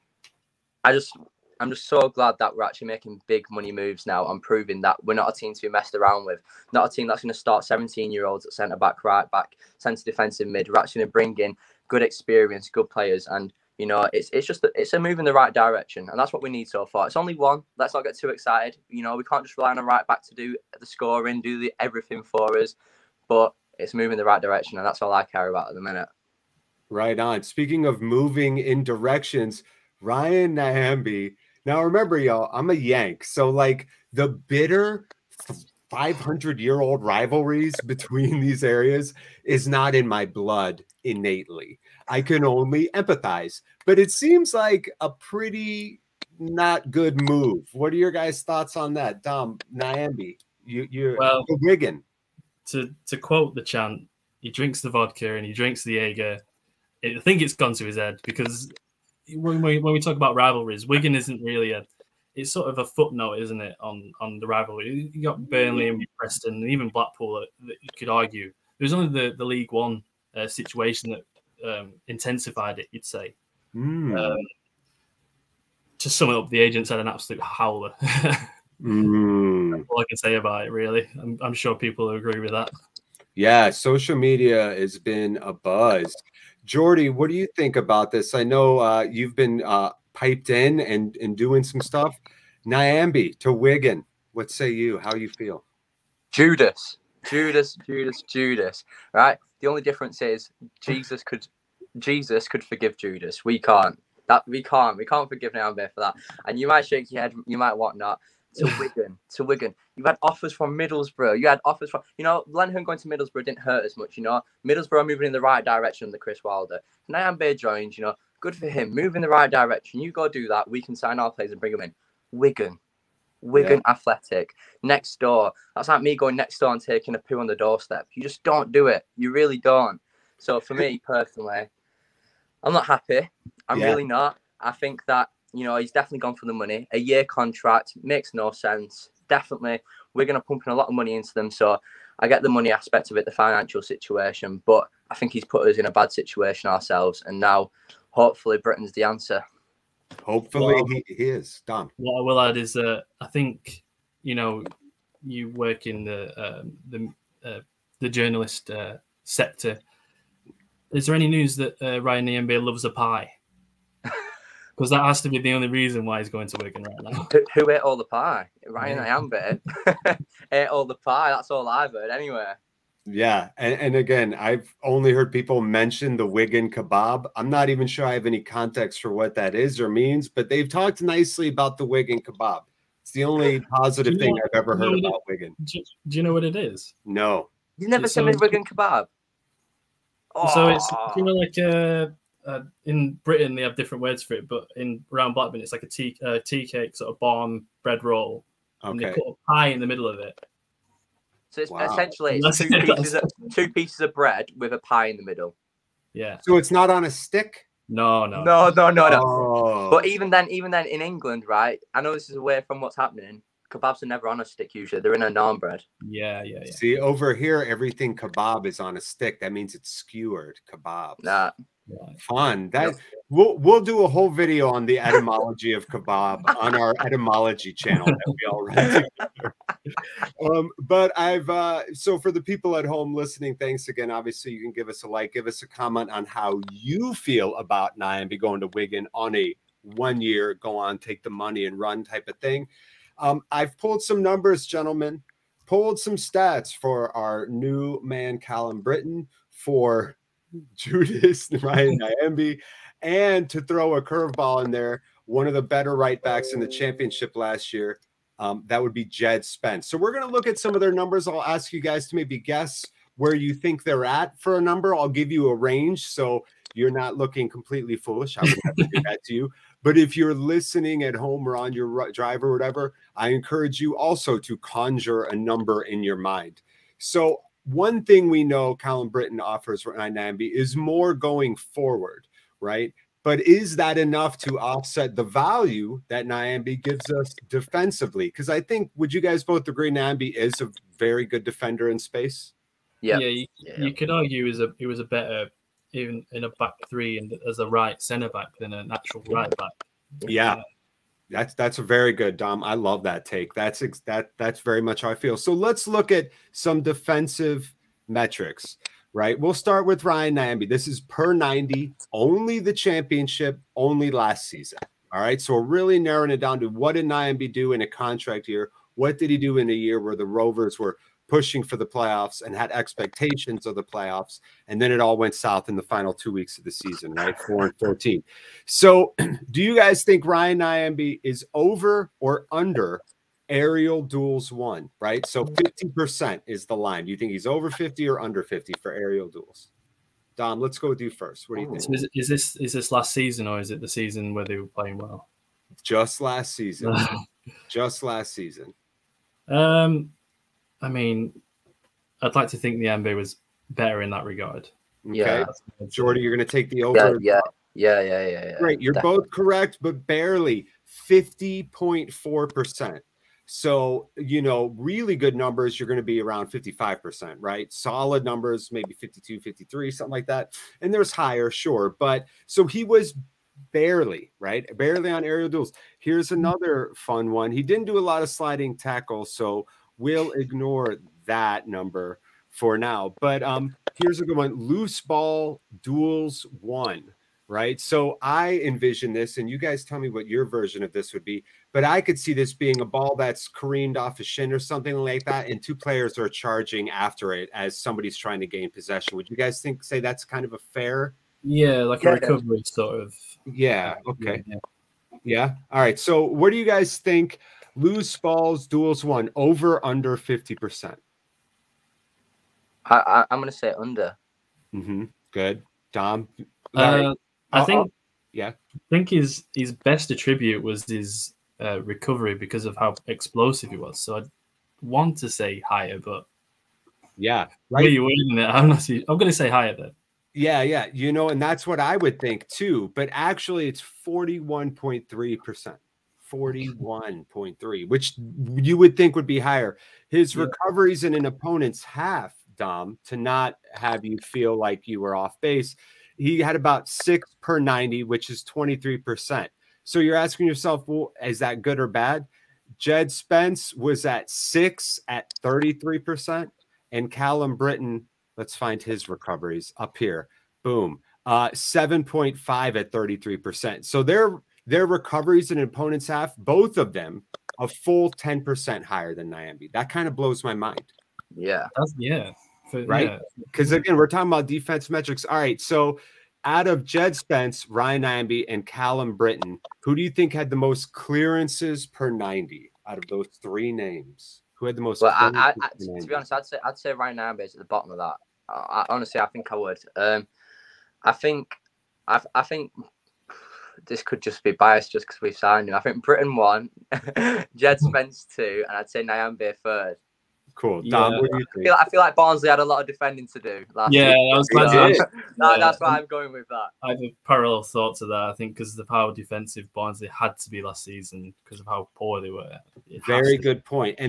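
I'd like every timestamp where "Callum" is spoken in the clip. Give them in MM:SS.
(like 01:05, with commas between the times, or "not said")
04:08, 07:37, 07:58.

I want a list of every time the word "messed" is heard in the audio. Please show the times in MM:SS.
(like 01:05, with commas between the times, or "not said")
00:05.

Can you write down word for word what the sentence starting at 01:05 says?
You got Burnley and Preston, and even Blackpool that, that you could argue.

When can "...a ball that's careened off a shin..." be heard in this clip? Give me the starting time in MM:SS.
06:32.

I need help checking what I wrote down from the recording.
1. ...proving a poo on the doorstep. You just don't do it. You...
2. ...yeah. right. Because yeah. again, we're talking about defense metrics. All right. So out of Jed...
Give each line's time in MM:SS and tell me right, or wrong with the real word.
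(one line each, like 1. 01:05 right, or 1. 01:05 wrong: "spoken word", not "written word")
1. 02:06 wrong: "taking", not "proving"
2. 07:51 right.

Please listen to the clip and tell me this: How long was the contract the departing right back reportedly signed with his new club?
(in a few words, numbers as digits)
1 year.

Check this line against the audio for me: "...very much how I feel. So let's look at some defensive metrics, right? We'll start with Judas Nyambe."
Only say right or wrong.
wrong.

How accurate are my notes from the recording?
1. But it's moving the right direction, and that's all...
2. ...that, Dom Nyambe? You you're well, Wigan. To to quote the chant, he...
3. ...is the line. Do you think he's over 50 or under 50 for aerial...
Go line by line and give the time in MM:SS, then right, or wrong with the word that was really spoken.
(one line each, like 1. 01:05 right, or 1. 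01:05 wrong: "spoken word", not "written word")
1. 00:23 right
2. 00:48 right
3. 05:36 right.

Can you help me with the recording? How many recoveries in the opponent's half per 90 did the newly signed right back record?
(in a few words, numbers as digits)
7.5.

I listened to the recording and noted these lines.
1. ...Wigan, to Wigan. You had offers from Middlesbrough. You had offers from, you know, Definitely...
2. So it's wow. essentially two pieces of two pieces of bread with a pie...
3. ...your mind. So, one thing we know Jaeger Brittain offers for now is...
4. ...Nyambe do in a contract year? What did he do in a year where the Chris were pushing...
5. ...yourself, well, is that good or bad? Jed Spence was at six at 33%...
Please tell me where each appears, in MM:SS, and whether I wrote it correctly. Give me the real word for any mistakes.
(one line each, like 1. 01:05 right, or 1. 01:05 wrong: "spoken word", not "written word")
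1. 01:48 wrong: "Lenihan", not "Definitely"
2. 03:21 right
3. 04:36 wrong: "Colin", not "Jaeger"
4. 05:17 wrong: "Rovers", not "Chris"
5. 07:30 right.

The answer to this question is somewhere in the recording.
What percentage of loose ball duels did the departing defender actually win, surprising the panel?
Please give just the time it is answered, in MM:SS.
07:13.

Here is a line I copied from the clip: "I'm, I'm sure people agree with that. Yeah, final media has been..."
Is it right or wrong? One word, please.
wrong.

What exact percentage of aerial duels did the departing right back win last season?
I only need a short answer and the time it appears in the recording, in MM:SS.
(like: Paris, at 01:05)
50.4%, at 06:01.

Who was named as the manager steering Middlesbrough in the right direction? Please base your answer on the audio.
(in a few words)
Chris Wilder.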